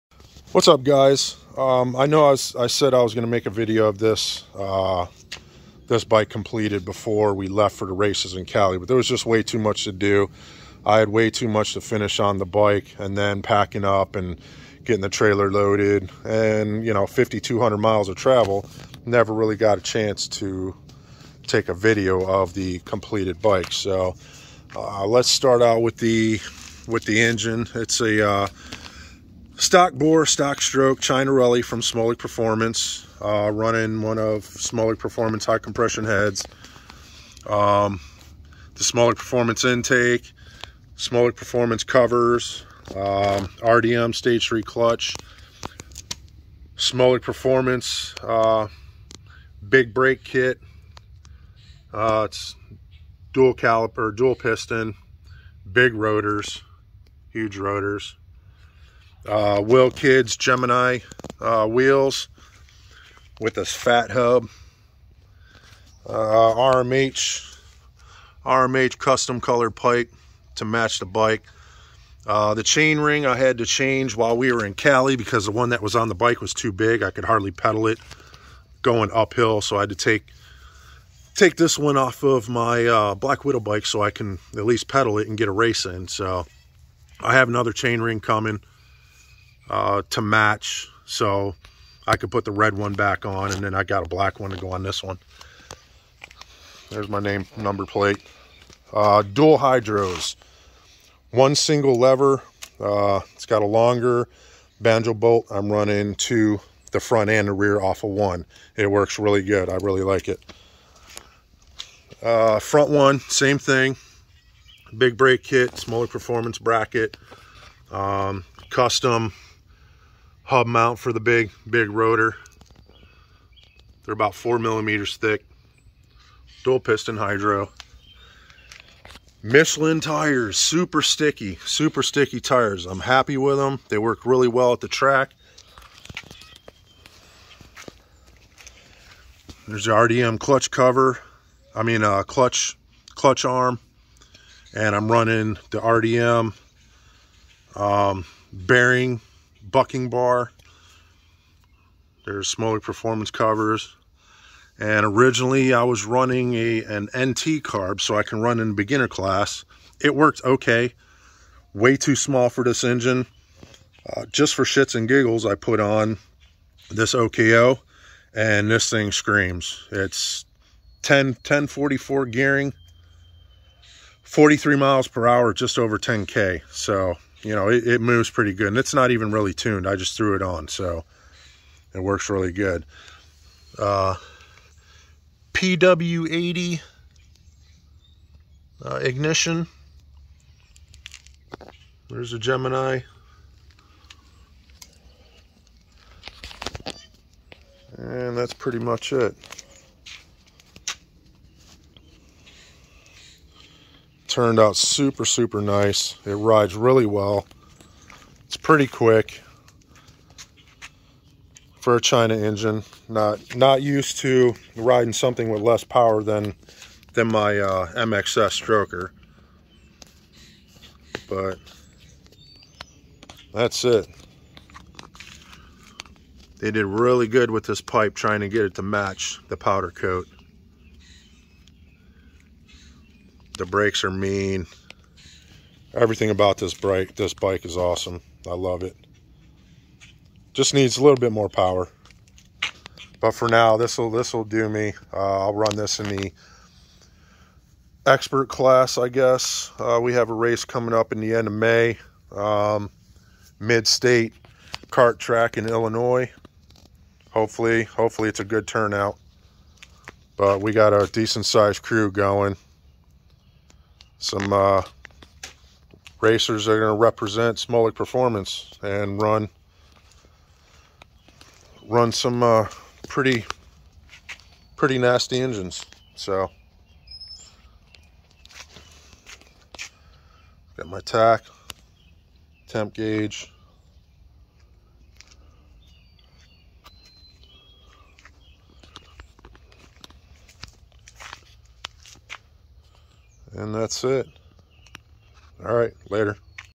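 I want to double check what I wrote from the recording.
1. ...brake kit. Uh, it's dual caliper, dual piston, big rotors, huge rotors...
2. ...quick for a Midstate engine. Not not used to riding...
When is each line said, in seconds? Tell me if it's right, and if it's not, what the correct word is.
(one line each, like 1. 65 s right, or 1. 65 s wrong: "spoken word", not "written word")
1. 49 s right
2. 208 s wrong: "China", not "Midstate".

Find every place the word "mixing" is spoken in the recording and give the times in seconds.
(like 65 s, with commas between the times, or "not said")
not said.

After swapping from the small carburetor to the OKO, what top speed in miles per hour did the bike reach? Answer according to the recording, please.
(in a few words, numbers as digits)
43.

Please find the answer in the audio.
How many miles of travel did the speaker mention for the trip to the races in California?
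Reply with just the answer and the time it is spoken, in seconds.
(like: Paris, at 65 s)
5,200, at 17 s.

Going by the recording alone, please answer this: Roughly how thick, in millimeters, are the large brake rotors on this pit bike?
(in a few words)
4 millimeters.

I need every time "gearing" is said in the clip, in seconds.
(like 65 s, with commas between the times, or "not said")
172 s.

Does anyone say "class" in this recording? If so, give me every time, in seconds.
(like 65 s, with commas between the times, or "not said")
159 s, 248 s.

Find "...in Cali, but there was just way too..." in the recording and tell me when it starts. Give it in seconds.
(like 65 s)
8 s.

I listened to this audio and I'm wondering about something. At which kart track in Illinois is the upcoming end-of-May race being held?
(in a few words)
Mid-state kart track.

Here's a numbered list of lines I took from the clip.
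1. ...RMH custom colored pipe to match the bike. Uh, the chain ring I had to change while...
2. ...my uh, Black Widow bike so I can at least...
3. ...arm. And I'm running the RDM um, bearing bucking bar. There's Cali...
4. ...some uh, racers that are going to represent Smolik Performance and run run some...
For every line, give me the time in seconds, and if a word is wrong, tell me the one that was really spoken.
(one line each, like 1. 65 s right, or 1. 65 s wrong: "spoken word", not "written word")
1. 68 s right
2. 82 s right
3. 143 s wrong: "Smolik", not "Cali"
4. 264 s right.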